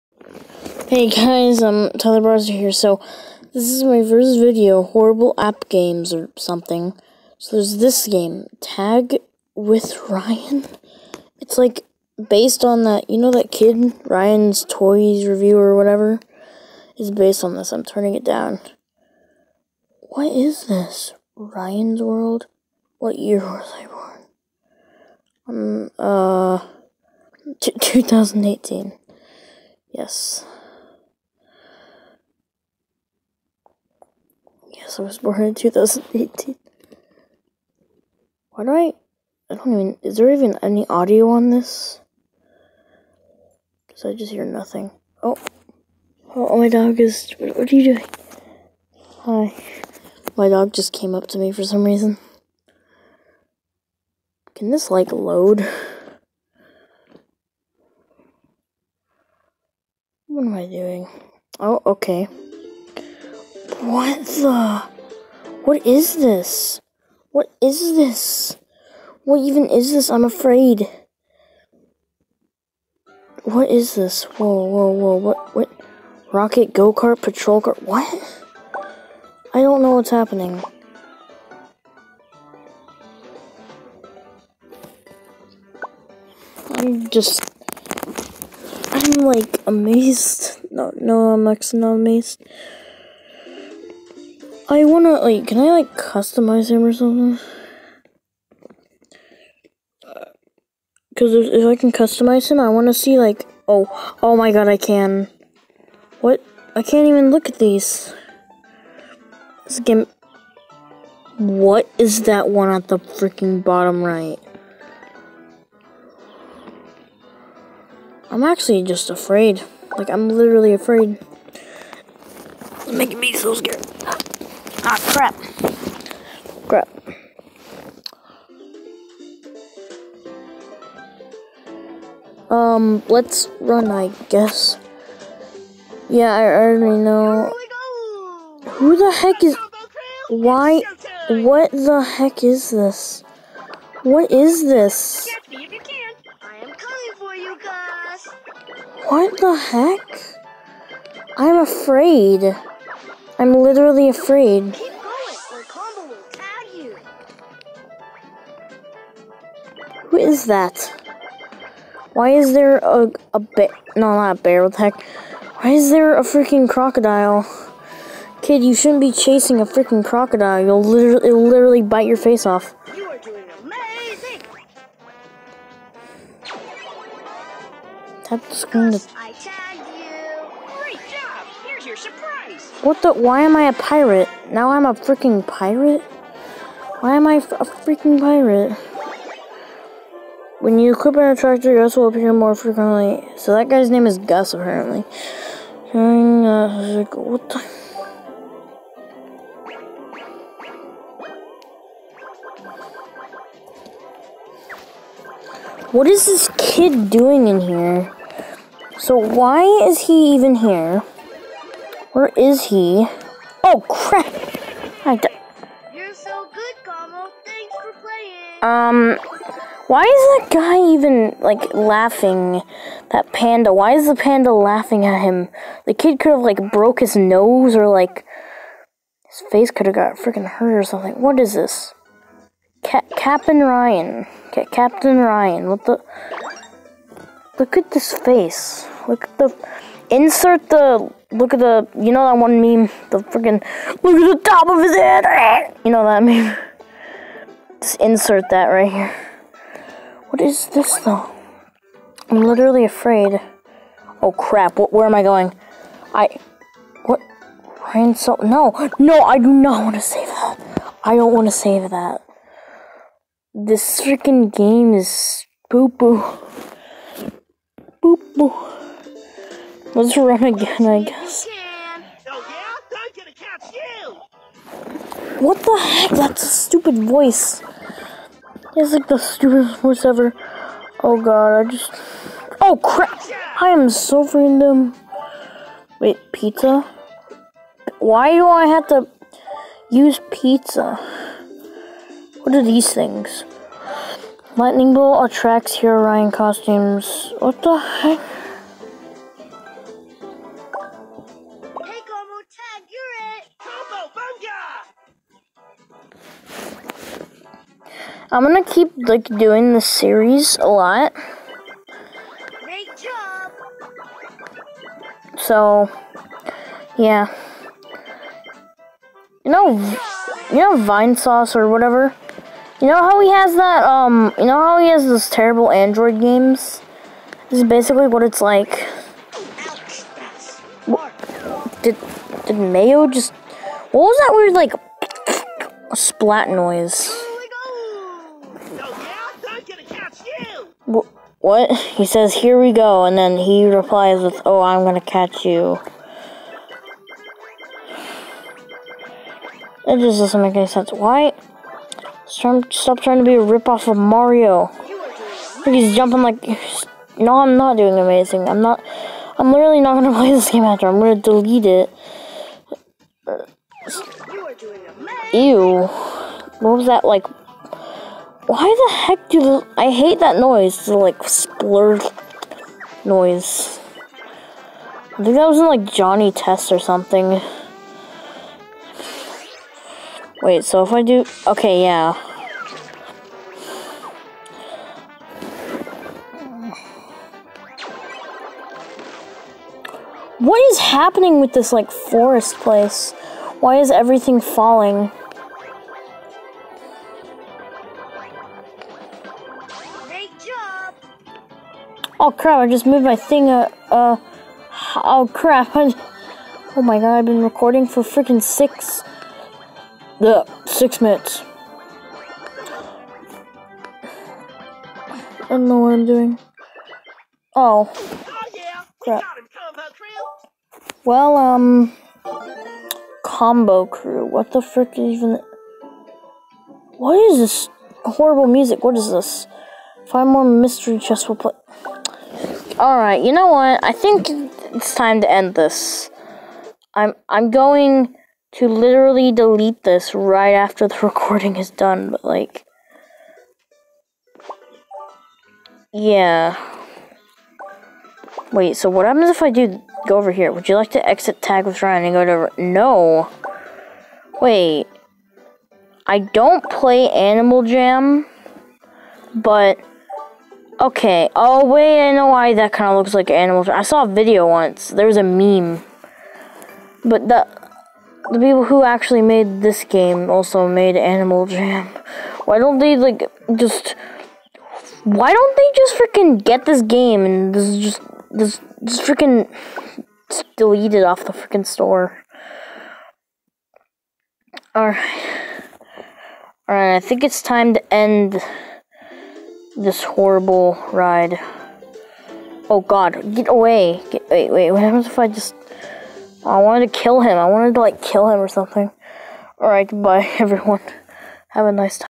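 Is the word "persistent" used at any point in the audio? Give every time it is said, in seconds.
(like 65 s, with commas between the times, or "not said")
not said.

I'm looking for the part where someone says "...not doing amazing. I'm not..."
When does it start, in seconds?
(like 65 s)
357 s.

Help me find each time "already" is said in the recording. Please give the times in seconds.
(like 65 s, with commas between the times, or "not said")
136 s.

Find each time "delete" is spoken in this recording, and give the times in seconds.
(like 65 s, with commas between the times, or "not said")
361 s, 439 s, 480 s.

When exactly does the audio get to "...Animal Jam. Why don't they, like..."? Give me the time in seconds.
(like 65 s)
470 s.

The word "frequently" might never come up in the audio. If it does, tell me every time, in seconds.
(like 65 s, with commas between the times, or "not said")
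192 s.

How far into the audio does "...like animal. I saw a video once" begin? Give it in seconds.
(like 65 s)
463 s.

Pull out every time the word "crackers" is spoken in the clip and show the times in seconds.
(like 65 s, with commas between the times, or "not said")
not said.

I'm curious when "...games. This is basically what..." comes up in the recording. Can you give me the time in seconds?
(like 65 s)
326 s.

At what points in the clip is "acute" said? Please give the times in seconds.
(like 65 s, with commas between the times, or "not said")
not said.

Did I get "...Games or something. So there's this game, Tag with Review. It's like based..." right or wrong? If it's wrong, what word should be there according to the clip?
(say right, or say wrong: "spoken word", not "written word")
wrong: "Ryan", not "Review".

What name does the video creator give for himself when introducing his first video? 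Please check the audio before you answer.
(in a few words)
Tyler Browser.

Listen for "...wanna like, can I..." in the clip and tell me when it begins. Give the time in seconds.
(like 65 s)
94 s.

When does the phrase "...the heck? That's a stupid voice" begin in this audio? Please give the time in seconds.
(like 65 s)
275 s.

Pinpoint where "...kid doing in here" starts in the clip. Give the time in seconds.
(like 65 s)
206 s.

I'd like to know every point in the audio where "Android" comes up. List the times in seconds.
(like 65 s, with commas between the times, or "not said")
325 s.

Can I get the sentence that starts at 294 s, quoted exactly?
Lightning bolt attracts hero Ryan costumes.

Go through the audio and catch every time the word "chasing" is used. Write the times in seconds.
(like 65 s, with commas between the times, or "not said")
169 s.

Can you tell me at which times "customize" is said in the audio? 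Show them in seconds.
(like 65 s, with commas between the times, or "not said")
95 s, 101 s.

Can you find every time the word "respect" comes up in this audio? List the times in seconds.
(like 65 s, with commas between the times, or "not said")
not said.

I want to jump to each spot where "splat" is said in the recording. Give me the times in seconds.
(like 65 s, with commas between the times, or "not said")
335 s.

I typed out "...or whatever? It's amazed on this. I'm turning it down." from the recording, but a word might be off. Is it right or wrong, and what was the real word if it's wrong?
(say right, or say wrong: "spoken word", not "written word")
wrong: "based", not "amazed".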